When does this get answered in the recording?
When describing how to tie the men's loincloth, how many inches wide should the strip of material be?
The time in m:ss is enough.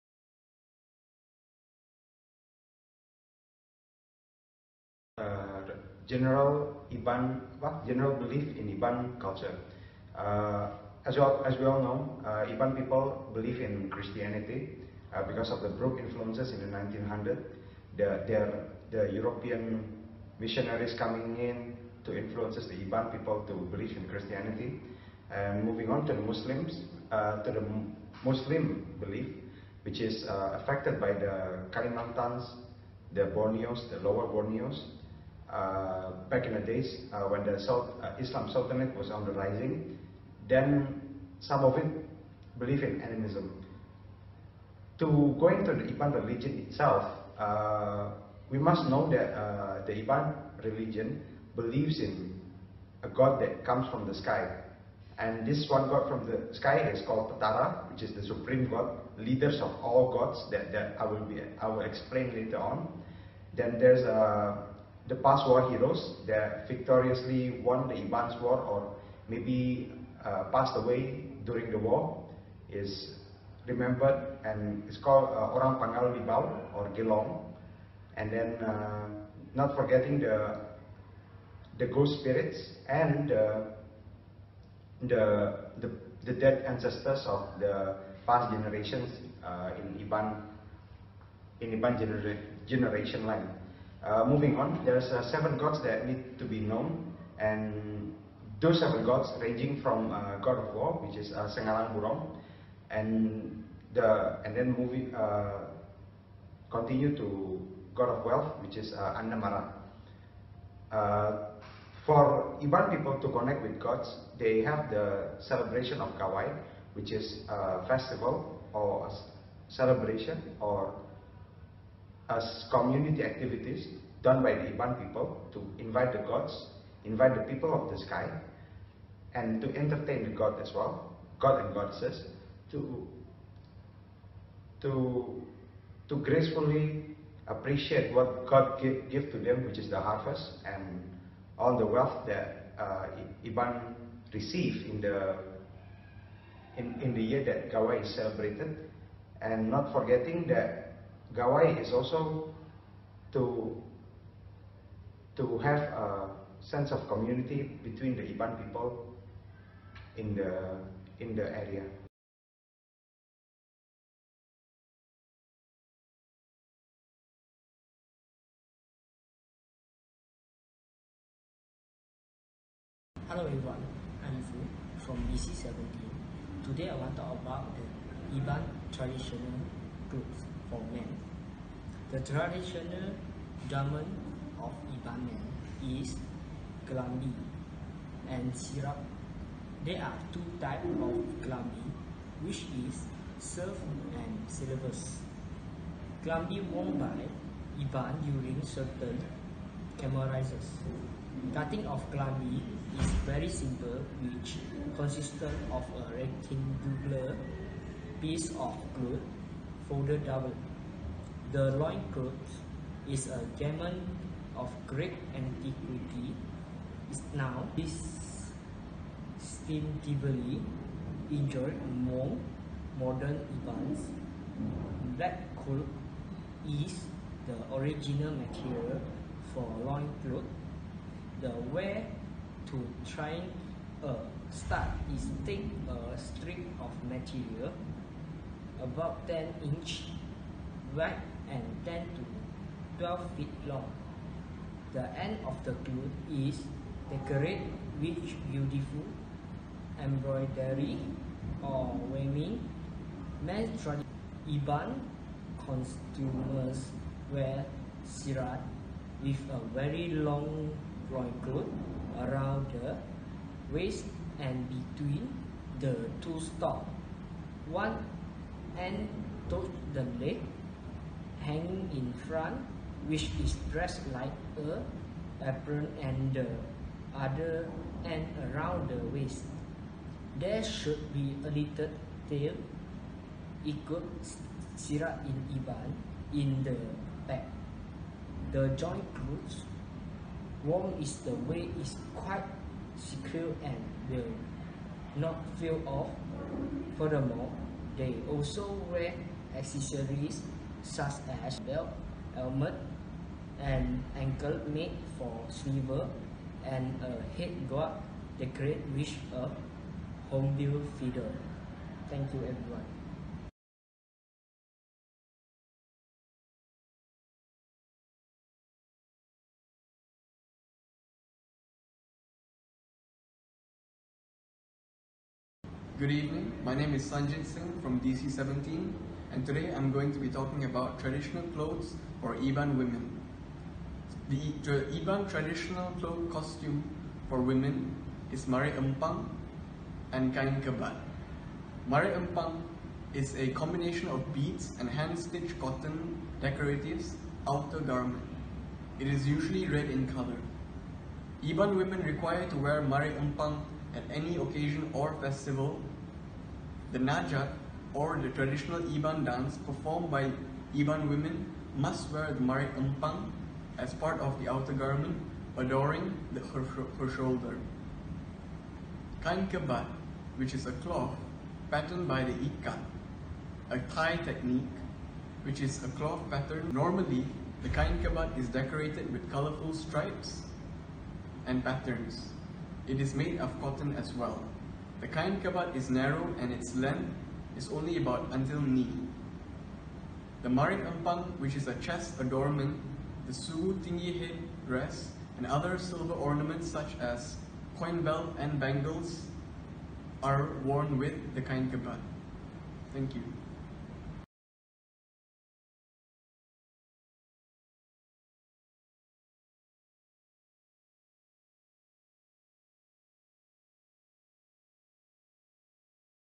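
3:59.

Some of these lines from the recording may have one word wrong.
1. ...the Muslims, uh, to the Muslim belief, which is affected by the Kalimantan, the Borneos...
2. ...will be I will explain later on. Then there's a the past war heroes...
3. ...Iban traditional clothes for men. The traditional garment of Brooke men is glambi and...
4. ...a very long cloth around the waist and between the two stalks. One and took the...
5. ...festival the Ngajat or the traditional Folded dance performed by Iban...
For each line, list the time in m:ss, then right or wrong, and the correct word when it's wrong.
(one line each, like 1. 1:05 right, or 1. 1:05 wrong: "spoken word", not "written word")
1. 0:26 right
2. 1:01 right
3. 2:58 wrong: "Iban", not "Brooke"
4. 4:19 right
5. 5:55 wrong: "Iban", not "Folded".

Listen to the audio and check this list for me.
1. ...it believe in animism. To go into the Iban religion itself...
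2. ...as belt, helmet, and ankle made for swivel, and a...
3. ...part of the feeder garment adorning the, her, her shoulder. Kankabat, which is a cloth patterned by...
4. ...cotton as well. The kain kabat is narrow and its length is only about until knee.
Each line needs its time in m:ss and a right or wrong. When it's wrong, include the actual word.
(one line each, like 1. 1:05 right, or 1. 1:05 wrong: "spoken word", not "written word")
1. 0:41 right
2. 5:01 right
3. 6:03 wrong: "outer", not "feeder"
4. 6:23 right.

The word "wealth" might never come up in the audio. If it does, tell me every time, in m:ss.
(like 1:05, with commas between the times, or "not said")
1:48, 2:21.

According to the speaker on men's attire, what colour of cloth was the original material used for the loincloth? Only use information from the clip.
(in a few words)
Black.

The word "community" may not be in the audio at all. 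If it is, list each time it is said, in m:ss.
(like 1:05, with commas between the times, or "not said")
2:02, 2:37.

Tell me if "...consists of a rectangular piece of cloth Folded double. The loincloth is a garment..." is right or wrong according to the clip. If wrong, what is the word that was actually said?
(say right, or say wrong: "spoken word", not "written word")
right.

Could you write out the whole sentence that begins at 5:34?
The, the Iban traditional cloth costume for women is Mare Empang and Kain kebat.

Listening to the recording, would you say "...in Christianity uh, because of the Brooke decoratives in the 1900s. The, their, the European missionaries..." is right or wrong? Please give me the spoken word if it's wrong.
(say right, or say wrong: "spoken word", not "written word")
wrong: "influences", not "decoratives".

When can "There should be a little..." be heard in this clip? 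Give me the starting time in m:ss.
4:40.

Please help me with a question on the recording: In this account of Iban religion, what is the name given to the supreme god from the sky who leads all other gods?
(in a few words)
Patara.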